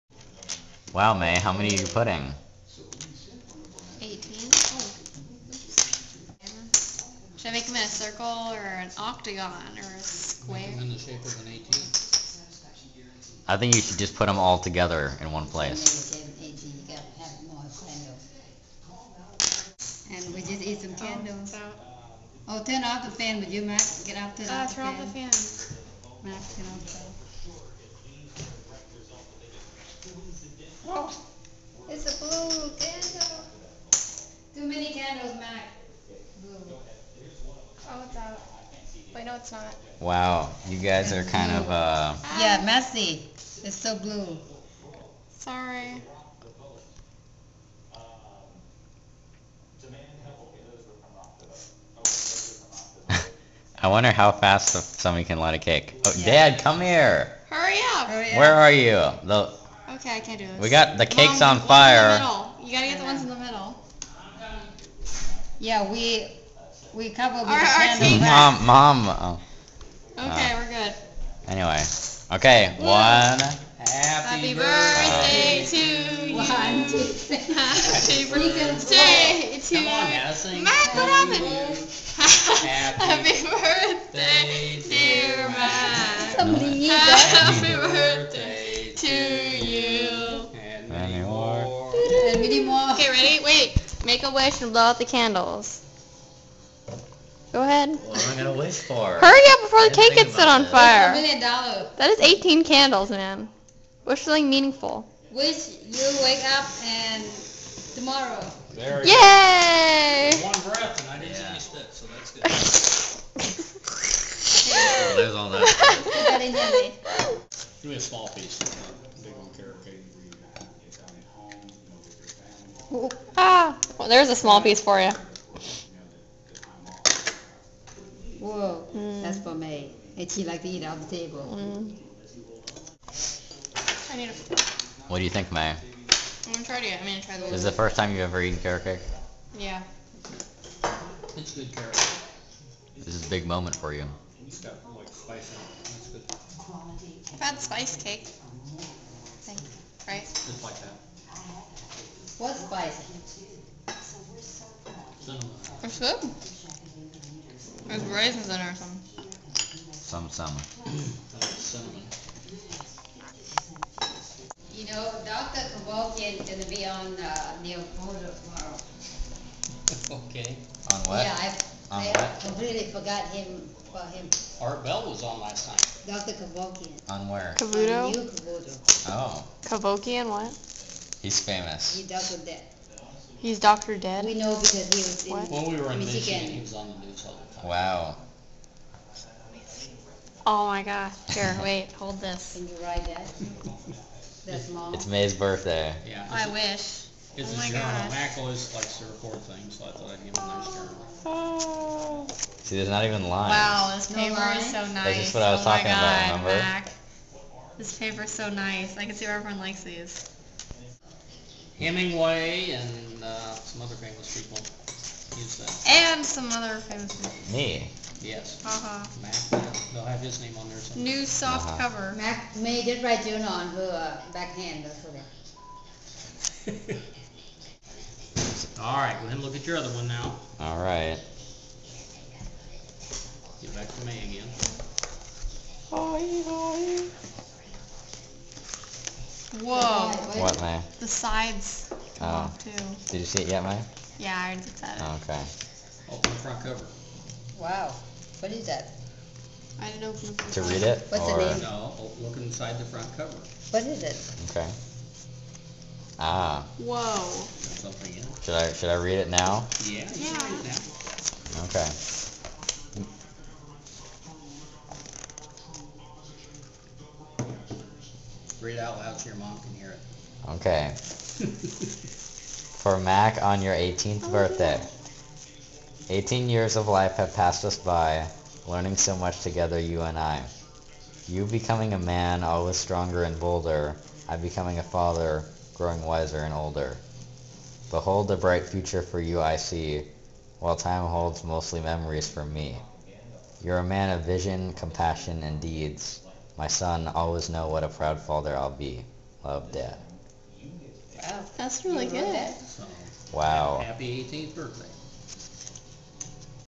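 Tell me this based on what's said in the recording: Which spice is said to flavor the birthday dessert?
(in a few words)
Cinnamon.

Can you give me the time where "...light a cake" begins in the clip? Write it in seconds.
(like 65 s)
55 s.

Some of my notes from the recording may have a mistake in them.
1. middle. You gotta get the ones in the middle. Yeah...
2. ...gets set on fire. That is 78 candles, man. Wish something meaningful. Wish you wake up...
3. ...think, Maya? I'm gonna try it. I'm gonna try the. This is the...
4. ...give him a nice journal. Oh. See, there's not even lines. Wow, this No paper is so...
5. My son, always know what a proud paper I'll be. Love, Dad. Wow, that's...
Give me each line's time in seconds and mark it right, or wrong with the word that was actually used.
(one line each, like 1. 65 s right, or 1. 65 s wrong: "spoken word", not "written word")
1. 62 s right
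2. 100 s wrong: "18", not "78"
3. 135 s right
4. 200 s right
5. 296 s wrong: "father", not "paper".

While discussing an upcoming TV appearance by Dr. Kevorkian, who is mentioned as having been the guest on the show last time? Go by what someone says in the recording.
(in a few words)
Art Bell.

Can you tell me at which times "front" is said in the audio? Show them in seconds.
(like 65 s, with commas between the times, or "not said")
246 s, 252 s.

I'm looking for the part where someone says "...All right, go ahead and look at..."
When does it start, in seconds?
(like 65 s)
228 s.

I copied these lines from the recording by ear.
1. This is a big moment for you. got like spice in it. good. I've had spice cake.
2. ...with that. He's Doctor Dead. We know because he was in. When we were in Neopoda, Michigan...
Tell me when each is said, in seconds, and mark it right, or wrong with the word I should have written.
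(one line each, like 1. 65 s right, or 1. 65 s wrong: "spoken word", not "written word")
1. 142 s right
2. 182 s wrong: "Michigan", not "Neopoda".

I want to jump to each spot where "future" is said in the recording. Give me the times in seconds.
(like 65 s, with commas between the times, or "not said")
288 s.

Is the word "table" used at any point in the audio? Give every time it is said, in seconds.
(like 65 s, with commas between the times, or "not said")
131 s.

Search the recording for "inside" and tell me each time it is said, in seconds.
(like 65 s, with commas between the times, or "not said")
252 s.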